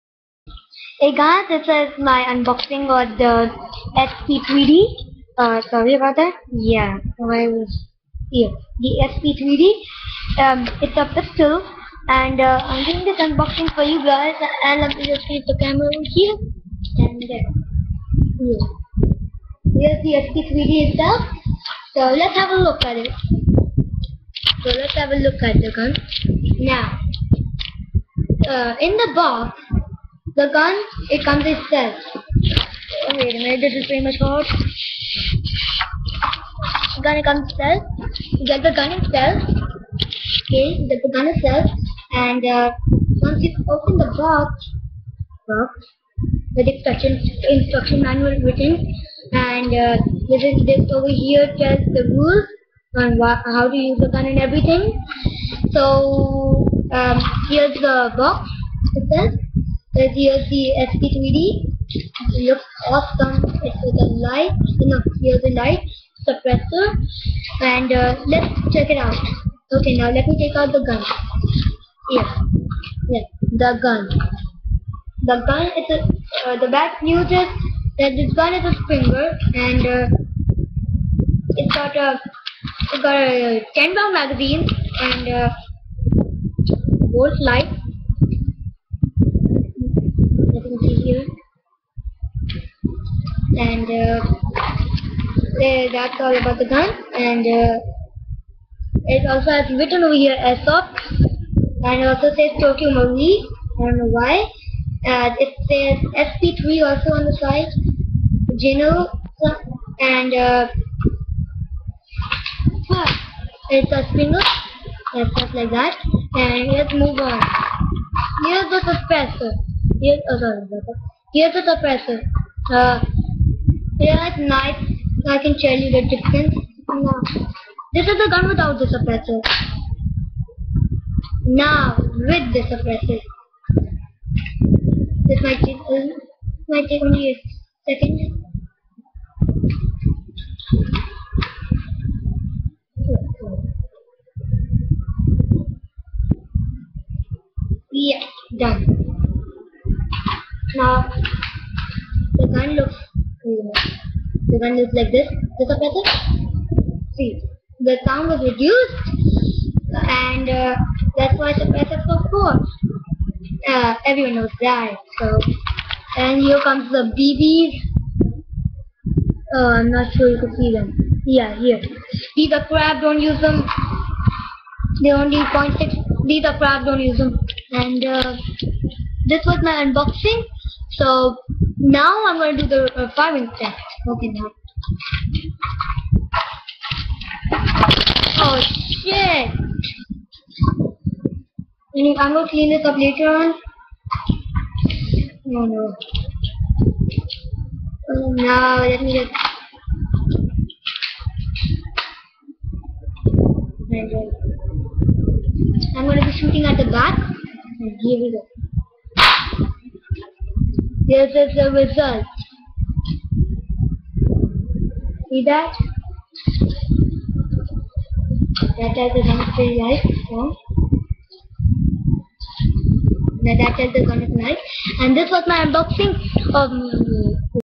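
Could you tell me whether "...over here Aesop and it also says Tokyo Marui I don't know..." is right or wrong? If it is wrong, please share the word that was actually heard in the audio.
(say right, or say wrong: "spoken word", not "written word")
right.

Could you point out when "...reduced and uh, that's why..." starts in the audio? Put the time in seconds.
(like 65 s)
158 s.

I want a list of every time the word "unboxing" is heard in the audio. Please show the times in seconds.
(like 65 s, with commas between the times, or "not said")
2 s, 13 s, 179 s, 225 s.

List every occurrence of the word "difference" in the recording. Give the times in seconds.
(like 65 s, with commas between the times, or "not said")
126 s.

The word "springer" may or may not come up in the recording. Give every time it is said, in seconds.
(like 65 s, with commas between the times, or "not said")
78 s, 114 s.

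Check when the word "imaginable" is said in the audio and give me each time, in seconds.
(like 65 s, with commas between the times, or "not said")
not said.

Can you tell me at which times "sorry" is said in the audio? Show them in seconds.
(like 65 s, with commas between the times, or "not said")
5 s, 120 s.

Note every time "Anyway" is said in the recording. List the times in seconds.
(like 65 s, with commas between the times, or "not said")
191 s.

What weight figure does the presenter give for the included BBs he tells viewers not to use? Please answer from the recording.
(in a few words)
0.6.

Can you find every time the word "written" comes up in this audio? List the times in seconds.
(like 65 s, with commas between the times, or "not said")
48 s, 99 s.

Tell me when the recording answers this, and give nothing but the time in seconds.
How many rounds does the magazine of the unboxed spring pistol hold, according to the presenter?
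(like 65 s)
83 s.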